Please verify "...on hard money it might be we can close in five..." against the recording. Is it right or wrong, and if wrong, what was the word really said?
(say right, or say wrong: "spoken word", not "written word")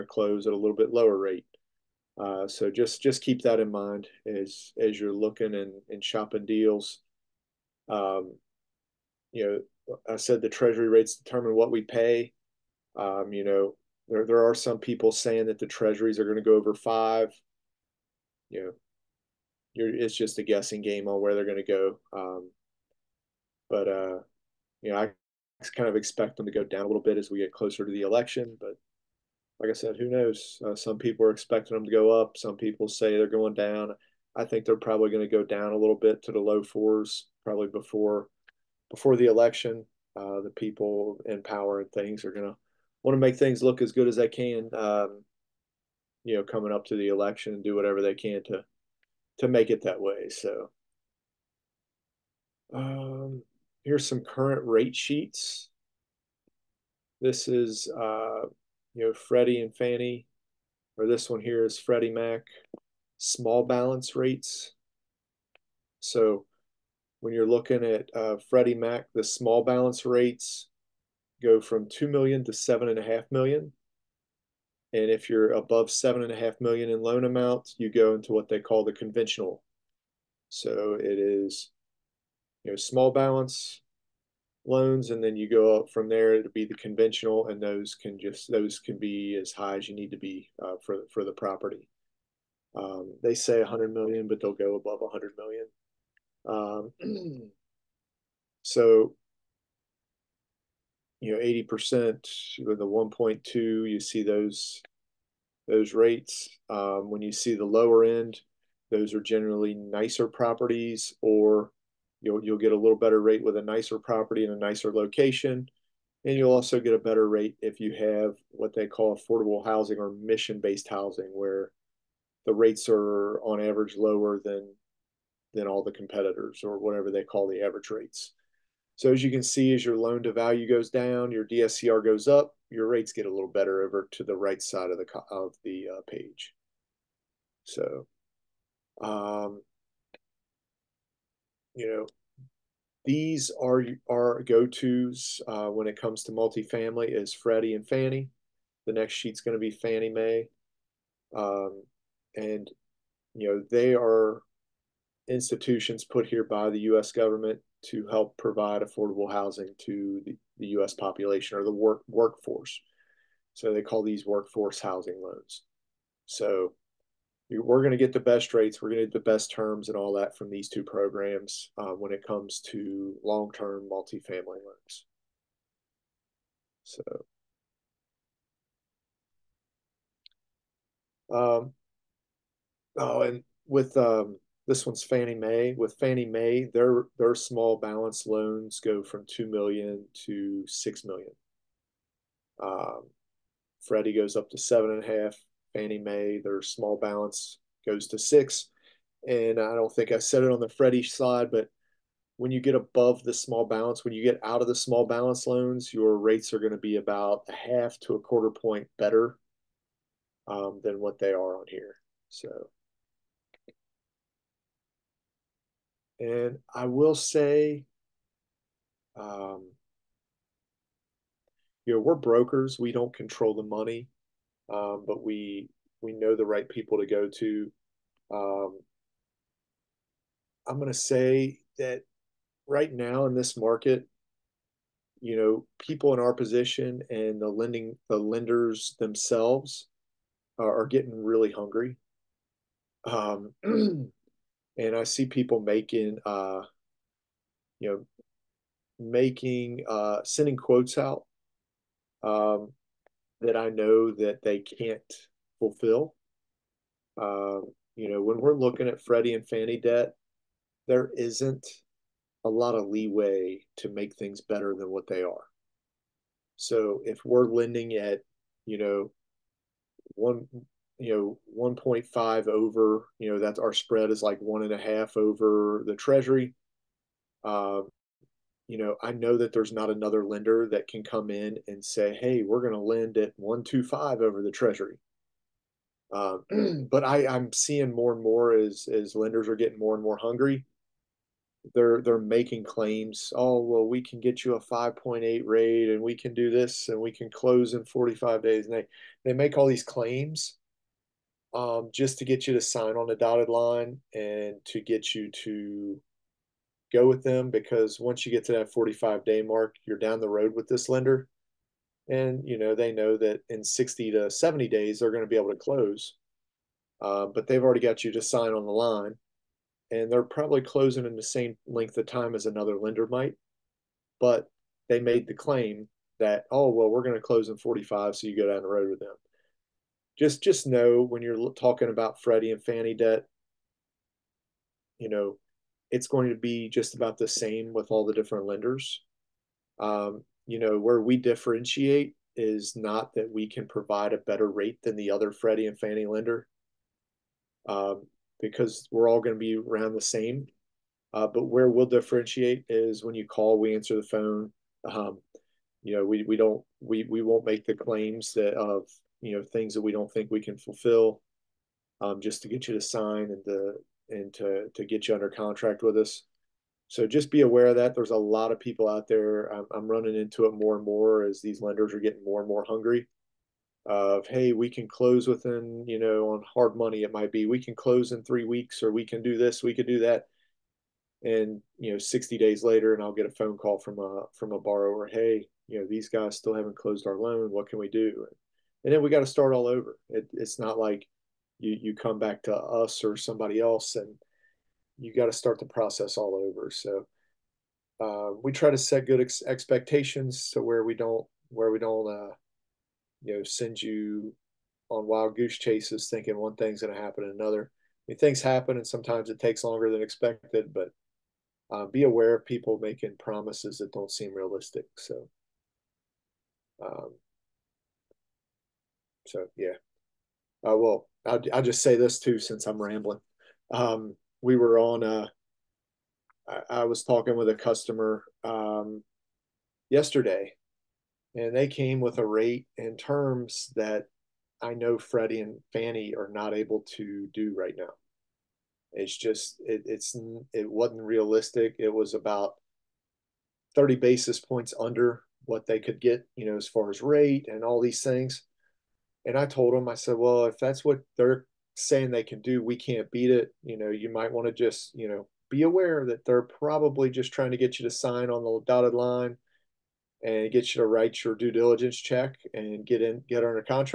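wrong: "three", not "five".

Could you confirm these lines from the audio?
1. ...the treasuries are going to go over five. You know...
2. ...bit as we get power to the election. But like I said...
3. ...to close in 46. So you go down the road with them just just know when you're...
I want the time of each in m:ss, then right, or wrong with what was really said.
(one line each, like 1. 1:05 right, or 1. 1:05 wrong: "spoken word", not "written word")
1. 0:15 right
2. 0:27 wrong: "closer", not "power"
3. 5:27 wrong: "45", not "46".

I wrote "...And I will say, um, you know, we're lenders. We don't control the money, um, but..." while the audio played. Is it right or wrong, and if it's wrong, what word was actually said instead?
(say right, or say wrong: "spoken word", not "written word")
wrong: "brokers", not "lenders".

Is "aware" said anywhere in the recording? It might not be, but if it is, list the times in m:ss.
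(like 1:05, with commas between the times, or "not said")
6:07, 6:52, 7:35.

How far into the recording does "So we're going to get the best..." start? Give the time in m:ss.
2:46.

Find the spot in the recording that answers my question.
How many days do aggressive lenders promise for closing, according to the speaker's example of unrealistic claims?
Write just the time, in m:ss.
4:57.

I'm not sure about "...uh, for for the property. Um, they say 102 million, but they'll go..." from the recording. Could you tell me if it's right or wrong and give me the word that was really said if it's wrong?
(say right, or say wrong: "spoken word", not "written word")
wrong: "100", not "102".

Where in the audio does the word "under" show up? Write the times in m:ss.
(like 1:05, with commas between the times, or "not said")
6:05, 7:24, 7:43.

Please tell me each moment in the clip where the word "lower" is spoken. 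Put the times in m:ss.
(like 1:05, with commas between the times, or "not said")
0:00, 1:47, 2:03.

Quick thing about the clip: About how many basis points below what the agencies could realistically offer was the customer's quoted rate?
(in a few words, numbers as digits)
30 basis points.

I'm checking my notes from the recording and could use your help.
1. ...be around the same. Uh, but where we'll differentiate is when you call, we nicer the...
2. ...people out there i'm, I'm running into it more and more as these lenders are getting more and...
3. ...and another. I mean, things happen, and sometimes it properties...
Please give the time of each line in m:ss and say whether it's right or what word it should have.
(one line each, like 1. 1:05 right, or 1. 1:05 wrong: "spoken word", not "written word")
1. 5:49 wrong: "answer", not "nicer"
2. 6:08 right
3. 6:47 wrong: "takes", not "properties".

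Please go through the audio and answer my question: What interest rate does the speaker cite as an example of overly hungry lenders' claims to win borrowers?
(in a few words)
5.8.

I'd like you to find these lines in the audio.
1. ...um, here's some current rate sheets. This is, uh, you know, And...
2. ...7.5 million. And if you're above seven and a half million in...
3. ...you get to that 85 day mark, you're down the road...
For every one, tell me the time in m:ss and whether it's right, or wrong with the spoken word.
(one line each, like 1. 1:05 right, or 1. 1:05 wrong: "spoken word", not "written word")
1. 0:52 wrong: "Freddie", not "And"
2. 1:12 right
3. 5:08 wrong: "45", not "85".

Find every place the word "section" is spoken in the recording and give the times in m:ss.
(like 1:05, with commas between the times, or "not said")
not said.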